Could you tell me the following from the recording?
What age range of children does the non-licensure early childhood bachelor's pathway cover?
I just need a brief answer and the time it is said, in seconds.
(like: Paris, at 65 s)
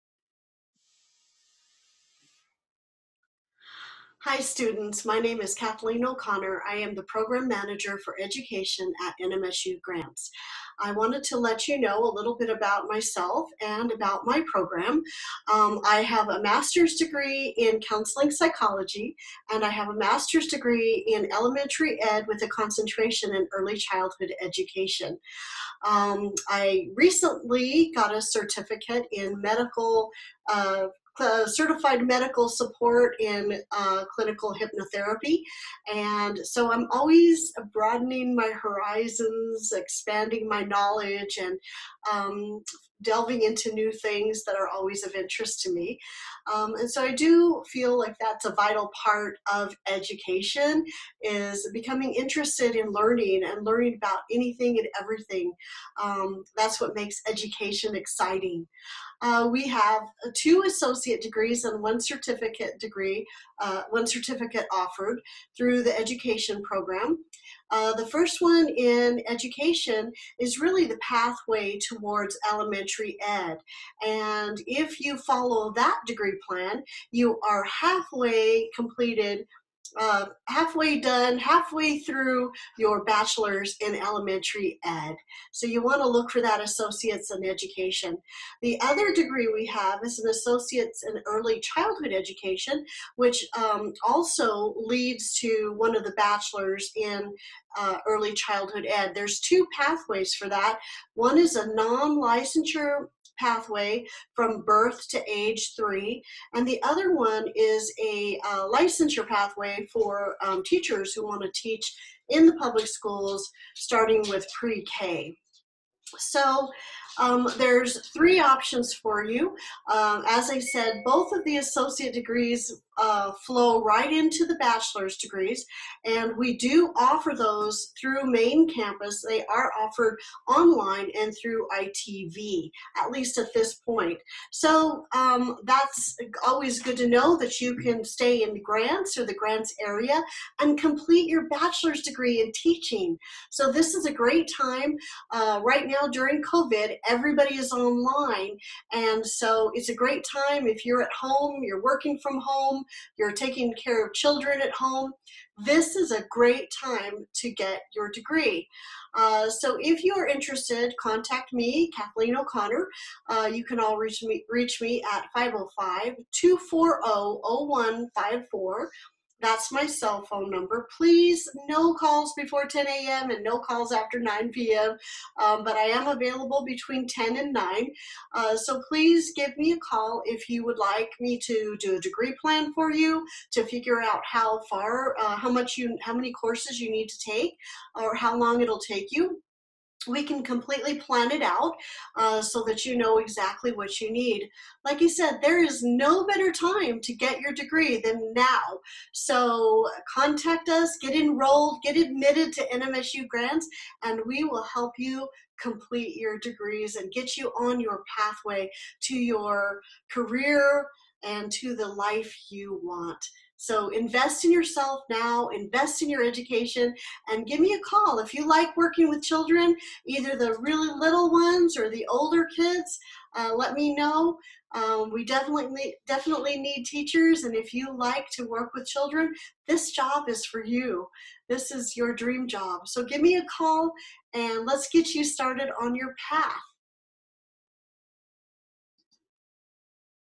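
Birth to age 3, at 104 s.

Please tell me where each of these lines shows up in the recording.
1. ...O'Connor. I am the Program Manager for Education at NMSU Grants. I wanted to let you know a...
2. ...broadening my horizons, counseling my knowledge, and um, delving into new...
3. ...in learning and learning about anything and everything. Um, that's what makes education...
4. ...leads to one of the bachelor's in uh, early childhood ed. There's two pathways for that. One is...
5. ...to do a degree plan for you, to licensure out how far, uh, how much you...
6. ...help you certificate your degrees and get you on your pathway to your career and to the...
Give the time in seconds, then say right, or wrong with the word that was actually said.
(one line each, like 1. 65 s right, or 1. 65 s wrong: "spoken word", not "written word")
1. 6 s right
2. 37 s wrong: "expanding", not "counseling"
3. 52 s right
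4. 94 s right
5. 181 s wrong: "figure", not "licensure"
6. 204 s wrong: "complete", not "certificate".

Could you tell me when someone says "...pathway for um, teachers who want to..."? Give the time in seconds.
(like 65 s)
109 s.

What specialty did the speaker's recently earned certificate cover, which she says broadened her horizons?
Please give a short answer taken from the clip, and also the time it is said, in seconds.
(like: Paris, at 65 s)
Clinical hypnotherapy, at 34 s.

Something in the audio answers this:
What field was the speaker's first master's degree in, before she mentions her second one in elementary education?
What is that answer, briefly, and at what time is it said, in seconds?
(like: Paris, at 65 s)
Counseling psychology, at 17 s.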